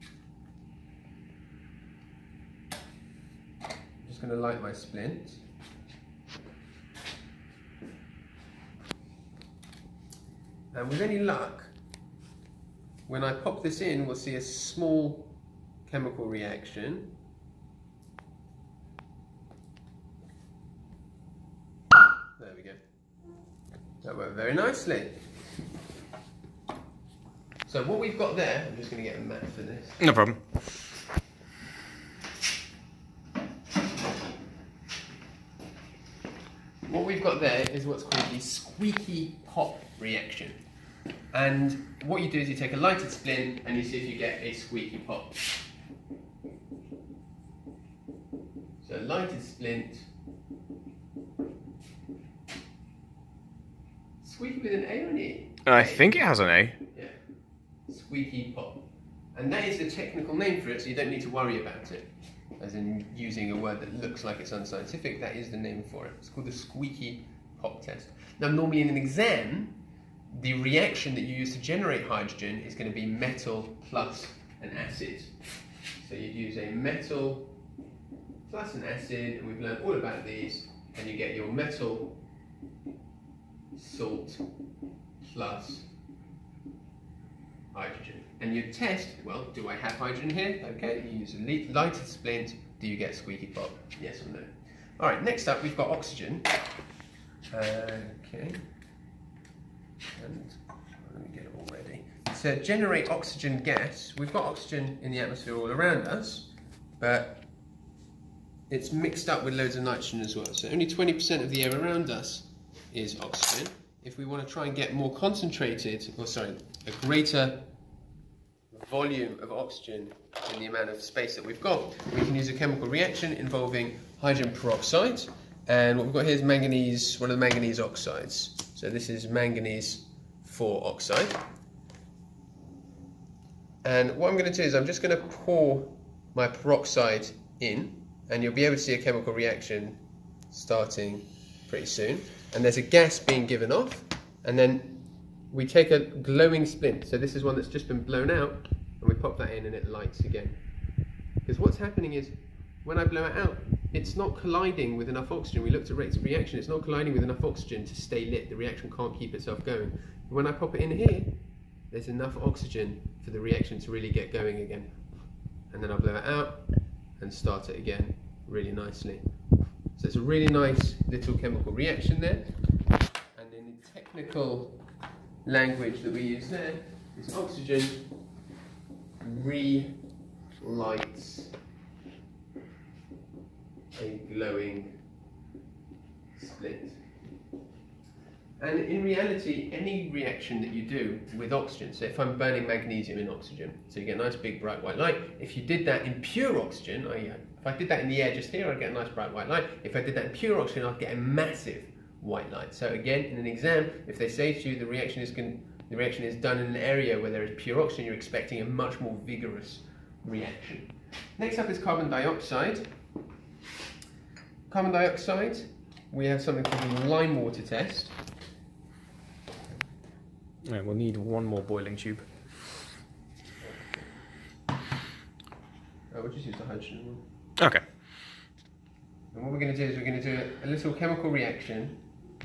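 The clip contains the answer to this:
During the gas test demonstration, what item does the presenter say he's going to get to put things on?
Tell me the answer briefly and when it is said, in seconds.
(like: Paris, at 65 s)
a mat, at 29 s.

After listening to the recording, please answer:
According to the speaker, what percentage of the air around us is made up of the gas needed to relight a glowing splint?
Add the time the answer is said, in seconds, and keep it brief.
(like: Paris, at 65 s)
20%, at 110 s.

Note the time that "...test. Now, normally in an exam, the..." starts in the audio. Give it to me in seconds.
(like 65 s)
67 s.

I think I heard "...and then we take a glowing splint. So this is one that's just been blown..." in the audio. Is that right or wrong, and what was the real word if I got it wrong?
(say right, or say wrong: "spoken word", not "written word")
right.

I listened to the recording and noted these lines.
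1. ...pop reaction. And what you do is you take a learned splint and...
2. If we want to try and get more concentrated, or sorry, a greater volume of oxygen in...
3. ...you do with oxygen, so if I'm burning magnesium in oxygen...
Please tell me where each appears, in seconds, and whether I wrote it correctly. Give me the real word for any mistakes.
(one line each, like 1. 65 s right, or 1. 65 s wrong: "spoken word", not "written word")
1. 39 s wrong: "lighted", not "learned"
2. 114 s right
3. 190 s right.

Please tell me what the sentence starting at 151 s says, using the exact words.
Because what's happening is when I blow it out, it's not colliding with enough oxygen.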